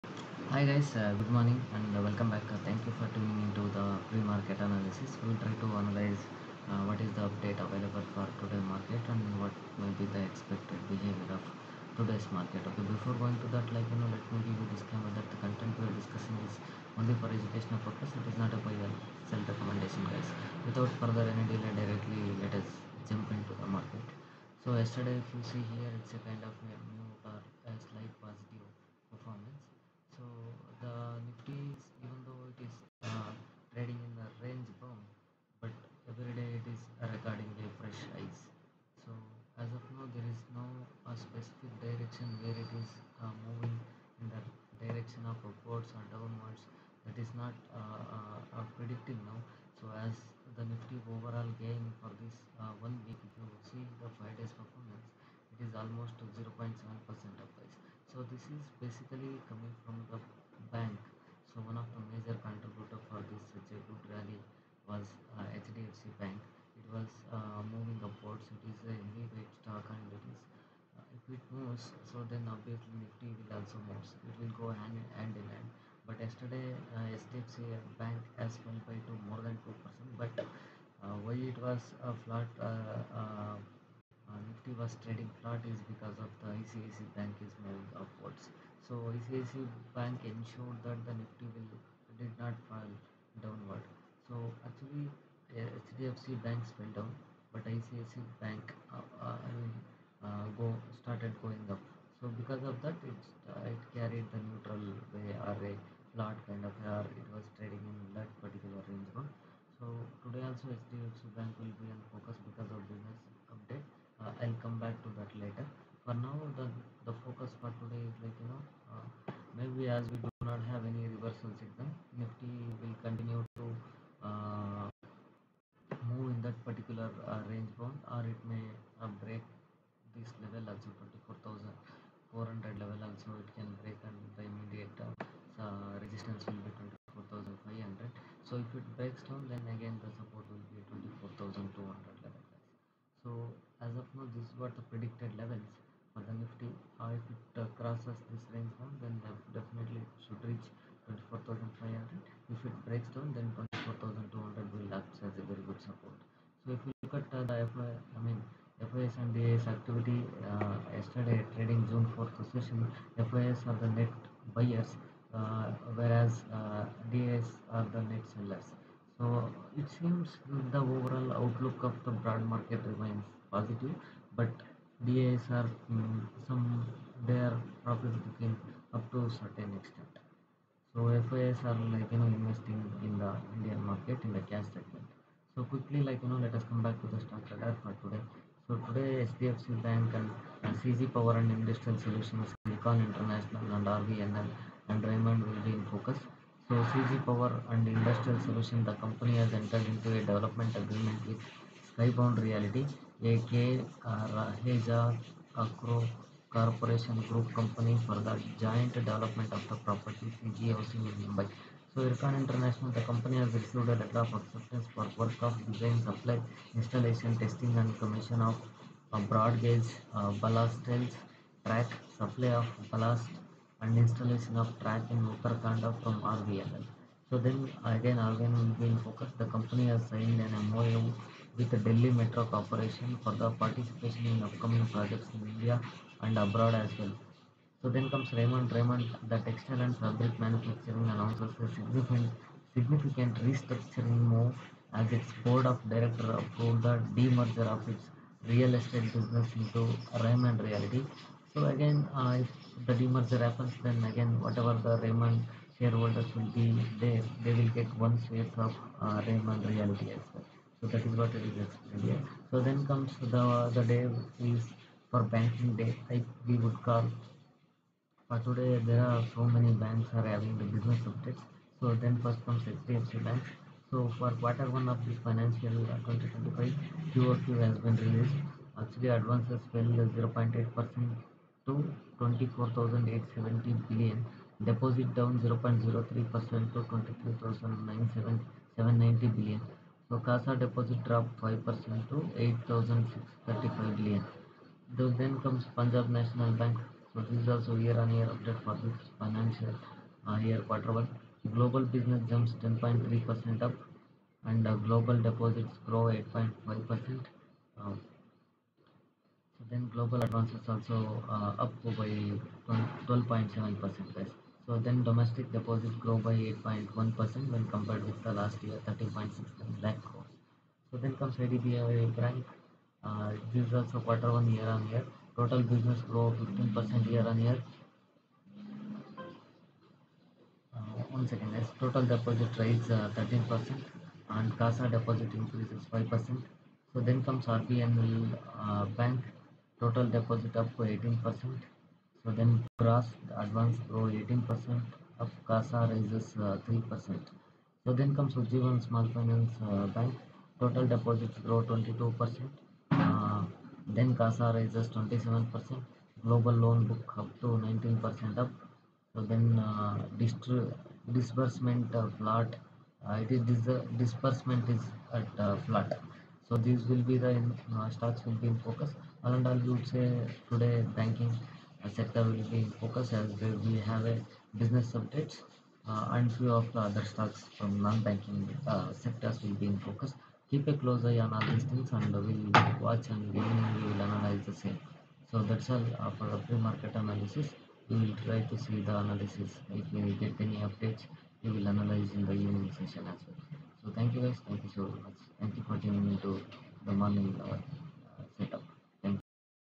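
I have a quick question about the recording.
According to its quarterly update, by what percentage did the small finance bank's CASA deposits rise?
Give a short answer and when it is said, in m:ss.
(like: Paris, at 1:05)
27%, at 5:54.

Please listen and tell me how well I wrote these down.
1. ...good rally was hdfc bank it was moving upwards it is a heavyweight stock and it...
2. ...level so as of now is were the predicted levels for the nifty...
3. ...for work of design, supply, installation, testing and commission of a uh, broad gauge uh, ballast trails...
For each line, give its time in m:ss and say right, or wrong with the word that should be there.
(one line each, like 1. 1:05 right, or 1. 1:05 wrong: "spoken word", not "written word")
1. 1:03 right
2. 2:22 right
3. 3:34 right.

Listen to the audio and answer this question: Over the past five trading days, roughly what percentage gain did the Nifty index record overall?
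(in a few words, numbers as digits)
0.7 percent.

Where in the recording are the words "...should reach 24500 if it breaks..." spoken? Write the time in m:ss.
2:30.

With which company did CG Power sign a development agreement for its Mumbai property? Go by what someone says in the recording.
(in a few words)
Skybound Reality.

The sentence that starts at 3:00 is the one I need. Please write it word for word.
So FIs are like you know investing in the Indian market in the cash segment.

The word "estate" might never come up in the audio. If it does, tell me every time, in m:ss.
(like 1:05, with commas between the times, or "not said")
4:08.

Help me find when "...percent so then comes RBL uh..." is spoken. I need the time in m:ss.
5:36.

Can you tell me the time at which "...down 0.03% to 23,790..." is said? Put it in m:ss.
4:45.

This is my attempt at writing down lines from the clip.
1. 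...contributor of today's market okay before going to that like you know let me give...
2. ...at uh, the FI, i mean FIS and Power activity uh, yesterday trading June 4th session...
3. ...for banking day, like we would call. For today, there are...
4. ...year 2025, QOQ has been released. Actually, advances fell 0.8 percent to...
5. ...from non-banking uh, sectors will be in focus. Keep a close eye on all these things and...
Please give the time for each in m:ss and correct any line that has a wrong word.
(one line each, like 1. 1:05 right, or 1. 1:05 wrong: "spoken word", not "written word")
1. 0:10 wrong: "behavior", not "contributor"
2. 2:37 wrong: "DAS", not "Power"
3. 4:25 right
4. 4:35 right
5. 6:17 right.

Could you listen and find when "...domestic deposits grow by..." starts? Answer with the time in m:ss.
5:15.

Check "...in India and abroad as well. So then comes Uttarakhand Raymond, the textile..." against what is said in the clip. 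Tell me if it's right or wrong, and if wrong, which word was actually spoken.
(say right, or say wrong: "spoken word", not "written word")
wrong: "Raymond", not "Uttarakhand".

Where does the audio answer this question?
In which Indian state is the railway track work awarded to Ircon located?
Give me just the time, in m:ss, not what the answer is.
3:45.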